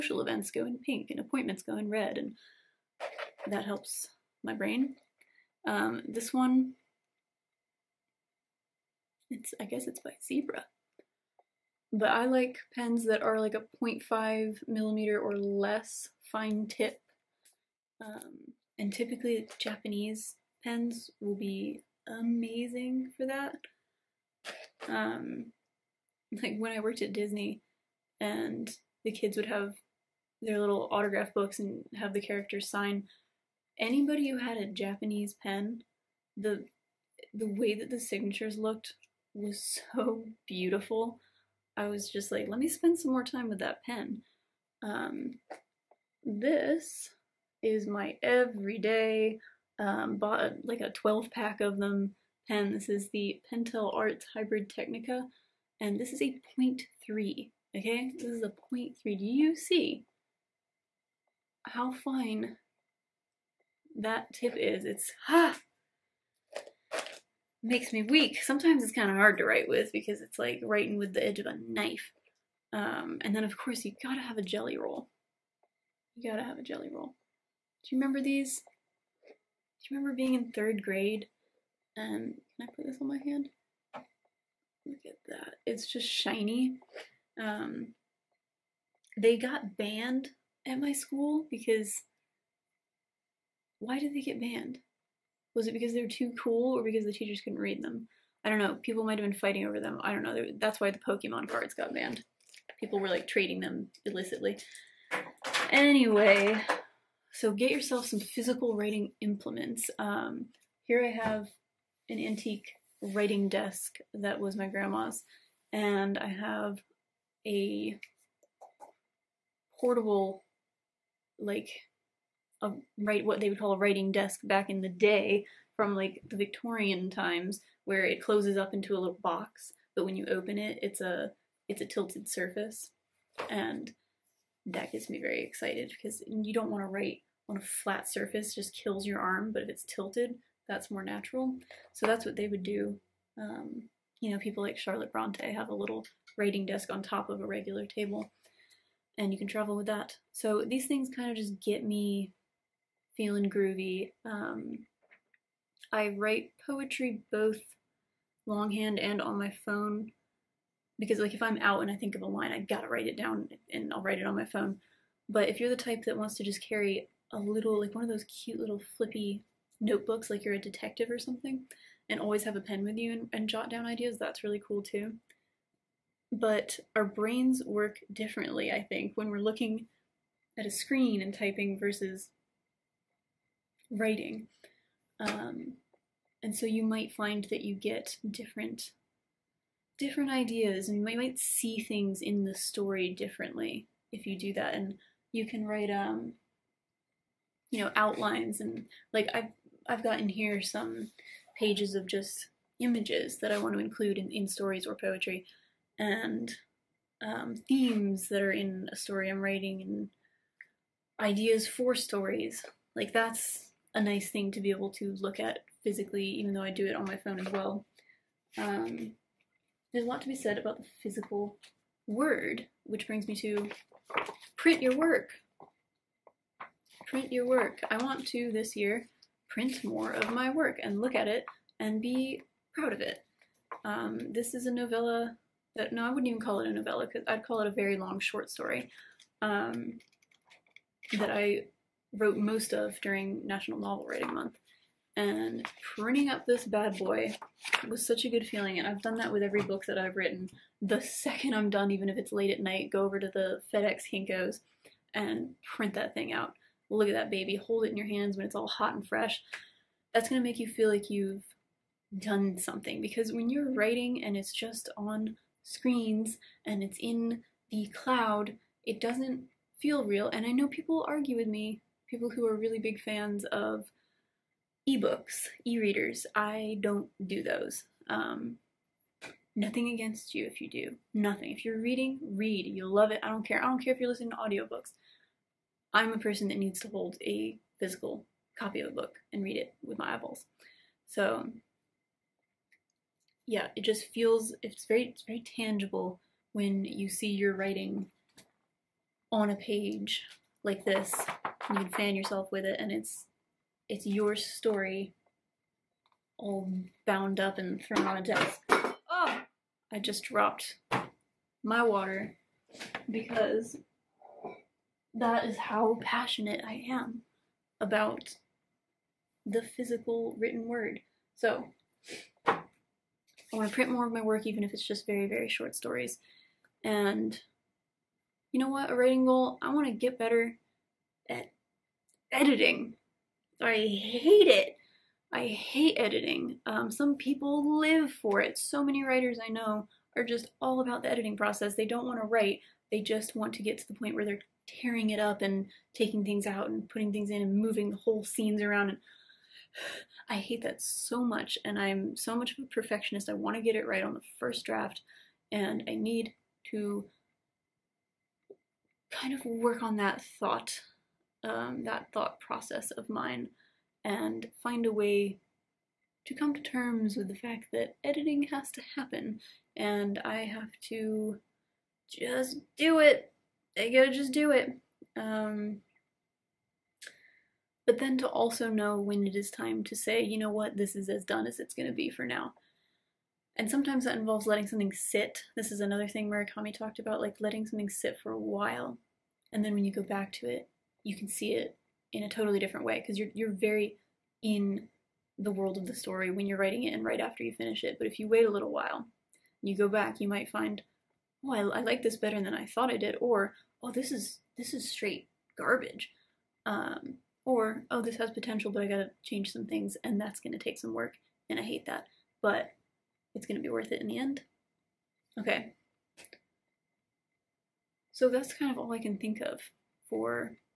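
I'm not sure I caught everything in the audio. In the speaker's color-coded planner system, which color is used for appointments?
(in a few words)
Red.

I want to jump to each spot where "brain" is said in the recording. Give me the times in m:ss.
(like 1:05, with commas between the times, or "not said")
0:04, 2:57.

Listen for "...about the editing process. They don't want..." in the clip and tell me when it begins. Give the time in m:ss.
5:40.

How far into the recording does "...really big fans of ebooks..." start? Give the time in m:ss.
4:32.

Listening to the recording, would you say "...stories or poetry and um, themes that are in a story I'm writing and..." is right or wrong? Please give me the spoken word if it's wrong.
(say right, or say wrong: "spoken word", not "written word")
right.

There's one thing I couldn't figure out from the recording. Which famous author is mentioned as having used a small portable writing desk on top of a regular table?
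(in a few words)
Charlotte Bronte.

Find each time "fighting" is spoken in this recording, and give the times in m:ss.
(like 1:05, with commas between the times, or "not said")
1:39.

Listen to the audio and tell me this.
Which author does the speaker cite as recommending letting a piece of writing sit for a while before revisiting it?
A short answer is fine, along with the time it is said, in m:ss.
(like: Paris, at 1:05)
Murakami, at 6:26.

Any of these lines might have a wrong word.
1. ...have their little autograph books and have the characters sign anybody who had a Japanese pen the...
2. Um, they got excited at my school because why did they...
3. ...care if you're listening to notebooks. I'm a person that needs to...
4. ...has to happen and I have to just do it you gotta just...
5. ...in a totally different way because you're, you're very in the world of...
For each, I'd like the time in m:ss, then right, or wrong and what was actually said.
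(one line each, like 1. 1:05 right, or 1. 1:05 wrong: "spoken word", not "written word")
1. 0:29 right
2. 1:27 wrong: "banned", not "excited"
3. 4:43 wrong: "audiobooks", not "notebooks"
4. 6:08 right
5. 6:32 right.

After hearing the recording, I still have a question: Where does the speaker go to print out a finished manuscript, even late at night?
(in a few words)
FedEx Kinko's.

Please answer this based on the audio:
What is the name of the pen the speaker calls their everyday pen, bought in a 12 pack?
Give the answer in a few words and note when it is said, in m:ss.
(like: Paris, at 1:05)
Pentel Arts Hybrid Technica, at 0:53.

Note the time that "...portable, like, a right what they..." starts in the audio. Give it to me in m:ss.
1:59.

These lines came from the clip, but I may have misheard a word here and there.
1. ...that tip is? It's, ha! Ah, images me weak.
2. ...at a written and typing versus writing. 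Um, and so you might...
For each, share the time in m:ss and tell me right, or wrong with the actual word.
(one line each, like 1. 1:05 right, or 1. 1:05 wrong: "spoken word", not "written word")
1. 1:03 wrong: "makes", not "images"
2. 3:00 wrong: "screen", not "written".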